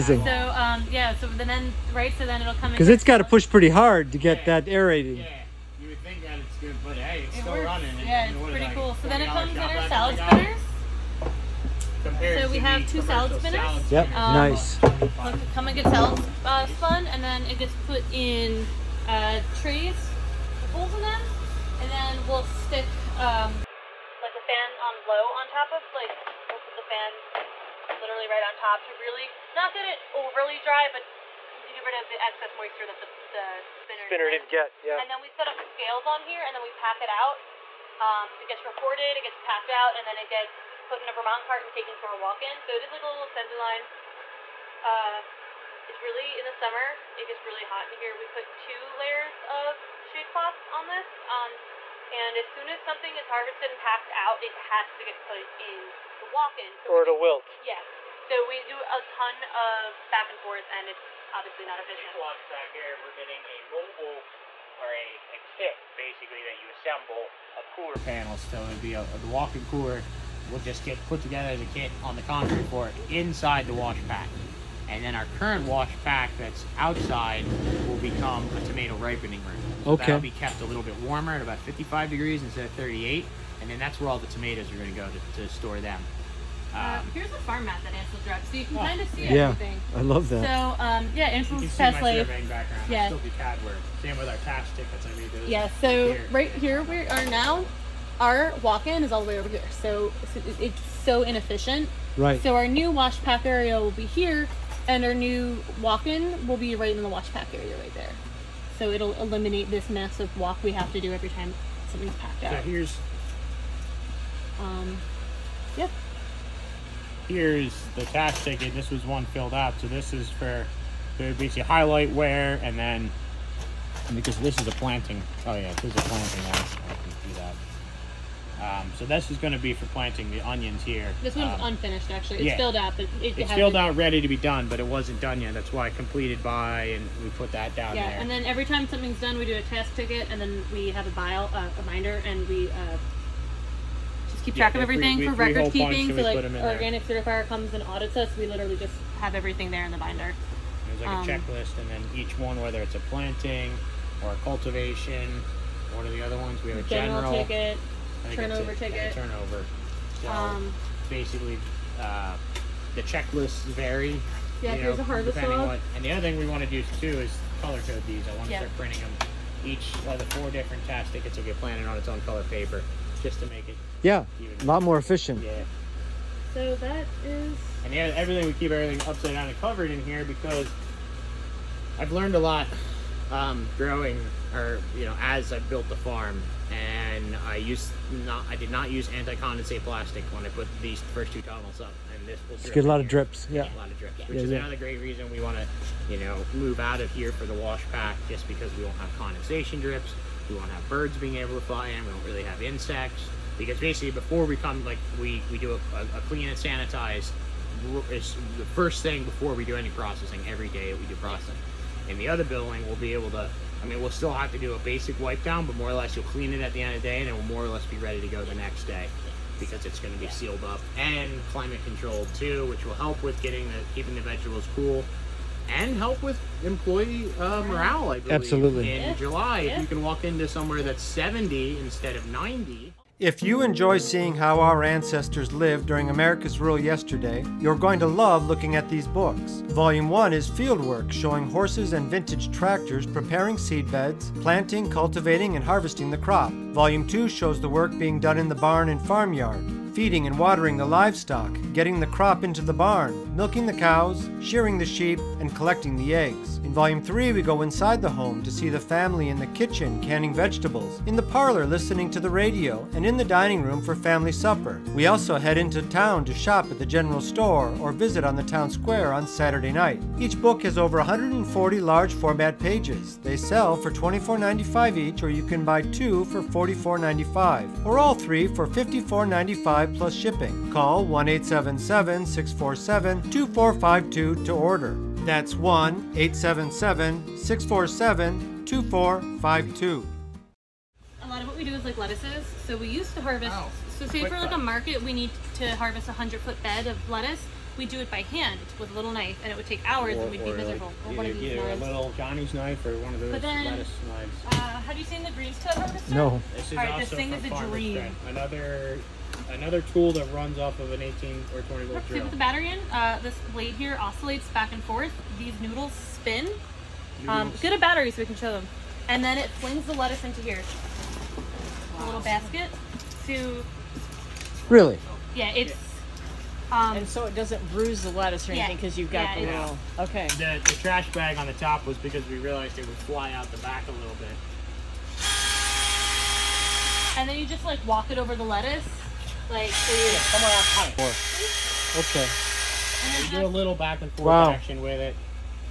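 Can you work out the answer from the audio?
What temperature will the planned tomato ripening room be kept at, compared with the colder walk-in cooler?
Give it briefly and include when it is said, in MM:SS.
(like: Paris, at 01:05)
55 degrees, at 01:21.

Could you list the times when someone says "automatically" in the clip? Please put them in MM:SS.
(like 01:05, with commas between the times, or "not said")
not said.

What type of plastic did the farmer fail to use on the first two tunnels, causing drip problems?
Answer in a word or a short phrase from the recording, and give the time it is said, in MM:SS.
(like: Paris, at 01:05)
anti-condensate plastic, at 03:09.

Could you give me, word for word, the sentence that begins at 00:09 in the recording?
So then it comes in our salad spinners.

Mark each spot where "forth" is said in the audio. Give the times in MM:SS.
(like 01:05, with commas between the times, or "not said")
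01:00, 05:14, 05:44.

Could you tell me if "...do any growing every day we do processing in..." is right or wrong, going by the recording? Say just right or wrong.
wrong.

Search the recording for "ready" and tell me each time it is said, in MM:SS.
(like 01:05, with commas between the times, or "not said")
02:13, 03:37.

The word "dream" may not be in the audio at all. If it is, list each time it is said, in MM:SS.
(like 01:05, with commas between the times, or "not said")
05:07.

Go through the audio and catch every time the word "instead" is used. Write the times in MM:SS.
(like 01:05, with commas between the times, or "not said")
01:22, 03:51.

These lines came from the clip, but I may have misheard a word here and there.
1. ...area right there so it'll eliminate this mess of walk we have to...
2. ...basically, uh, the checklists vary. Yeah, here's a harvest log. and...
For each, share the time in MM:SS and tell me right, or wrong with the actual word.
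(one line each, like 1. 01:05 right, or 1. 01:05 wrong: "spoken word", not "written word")
1. 01:47 right
2. 02:41 right.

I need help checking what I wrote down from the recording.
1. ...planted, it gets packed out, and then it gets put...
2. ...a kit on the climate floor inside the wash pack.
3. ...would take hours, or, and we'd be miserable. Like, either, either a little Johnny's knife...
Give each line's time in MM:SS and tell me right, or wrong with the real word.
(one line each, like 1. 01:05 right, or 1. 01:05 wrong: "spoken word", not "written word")
1. 00:38 wrong: "recorded", not "planted"
2. 01:11 wrong: "concrete", not "climate"
3. 04:59 right.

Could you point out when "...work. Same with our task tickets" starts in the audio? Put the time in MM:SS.
01:33.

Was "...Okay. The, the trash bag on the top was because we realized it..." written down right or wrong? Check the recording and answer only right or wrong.
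right.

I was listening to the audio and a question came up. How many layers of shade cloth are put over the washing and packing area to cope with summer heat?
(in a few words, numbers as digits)
2.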